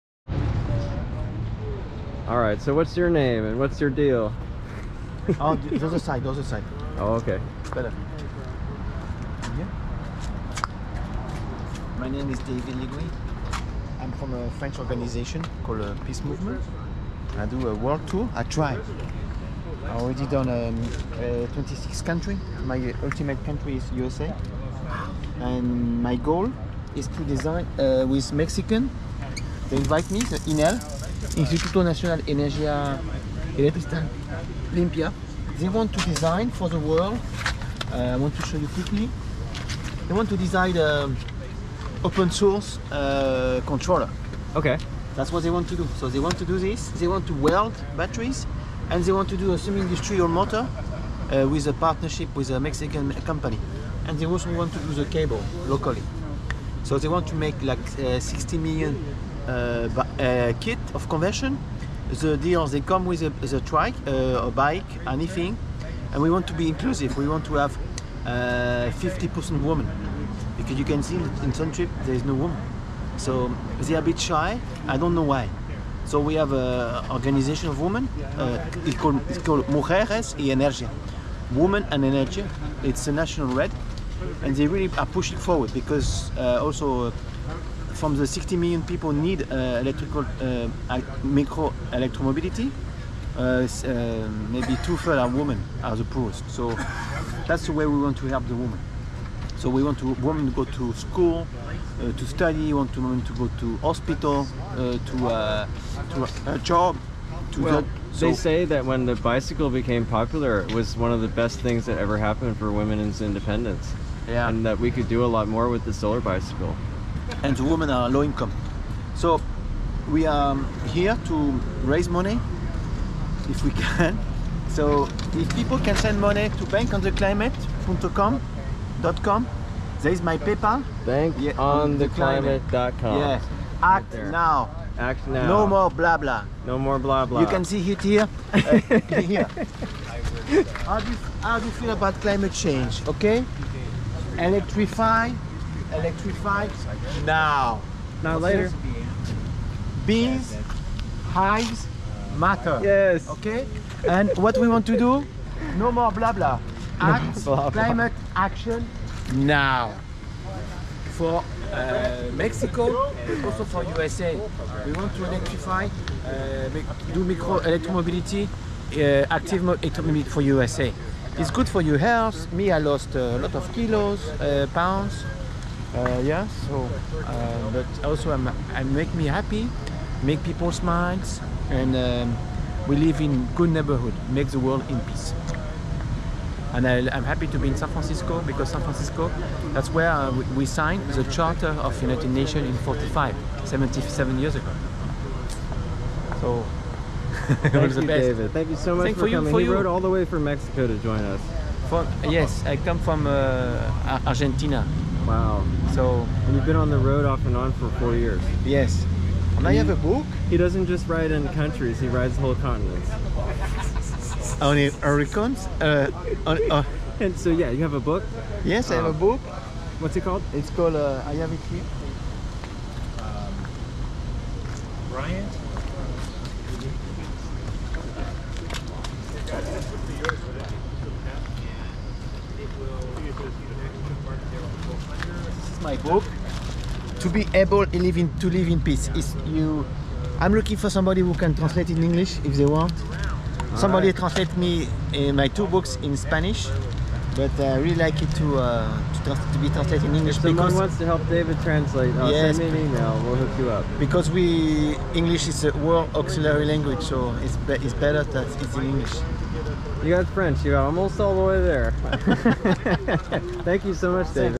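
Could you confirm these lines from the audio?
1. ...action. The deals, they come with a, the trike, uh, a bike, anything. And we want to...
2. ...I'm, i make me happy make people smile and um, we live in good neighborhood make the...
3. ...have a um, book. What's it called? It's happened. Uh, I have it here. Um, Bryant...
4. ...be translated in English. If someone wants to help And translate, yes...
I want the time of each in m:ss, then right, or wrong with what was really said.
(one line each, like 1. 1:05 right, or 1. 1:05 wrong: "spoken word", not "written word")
1. 1:01 wrong: "convention", not "action"
2. 2:58 right
3. 3:38 wrong: "called", not "happened"
4. 4:09 wrong: "David", not "And".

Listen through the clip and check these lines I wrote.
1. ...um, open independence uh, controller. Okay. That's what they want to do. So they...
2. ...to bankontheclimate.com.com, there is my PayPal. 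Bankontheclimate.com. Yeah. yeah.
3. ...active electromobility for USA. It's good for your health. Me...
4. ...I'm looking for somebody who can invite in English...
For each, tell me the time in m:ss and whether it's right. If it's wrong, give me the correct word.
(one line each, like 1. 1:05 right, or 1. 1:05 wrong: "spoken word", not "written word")
1. 0:41 wrong: "source", not "independence"
2. 2:06 right
3. 2:49 right
4. 4:00 wrong: "translate", not "invite".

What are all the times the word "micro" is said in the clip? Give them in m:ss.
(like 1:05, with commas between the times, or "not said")
1:31, 2:47.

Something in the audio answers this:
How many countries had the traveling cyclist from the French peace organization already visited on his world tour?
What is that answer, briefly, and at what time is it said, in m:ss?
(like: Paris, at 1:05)
26, at 0:21.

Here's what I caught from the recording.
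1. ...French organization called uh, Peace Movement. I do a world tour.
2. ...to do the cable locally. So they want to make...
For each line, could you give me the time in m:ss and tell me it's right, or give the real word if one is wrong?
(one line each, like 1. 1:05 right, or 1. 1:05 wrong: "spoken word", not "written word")
1. 0:14 right
2. 0:54 right.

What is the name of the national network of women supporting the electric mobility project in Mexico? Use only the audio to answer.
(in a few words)
Mujeres y Energía.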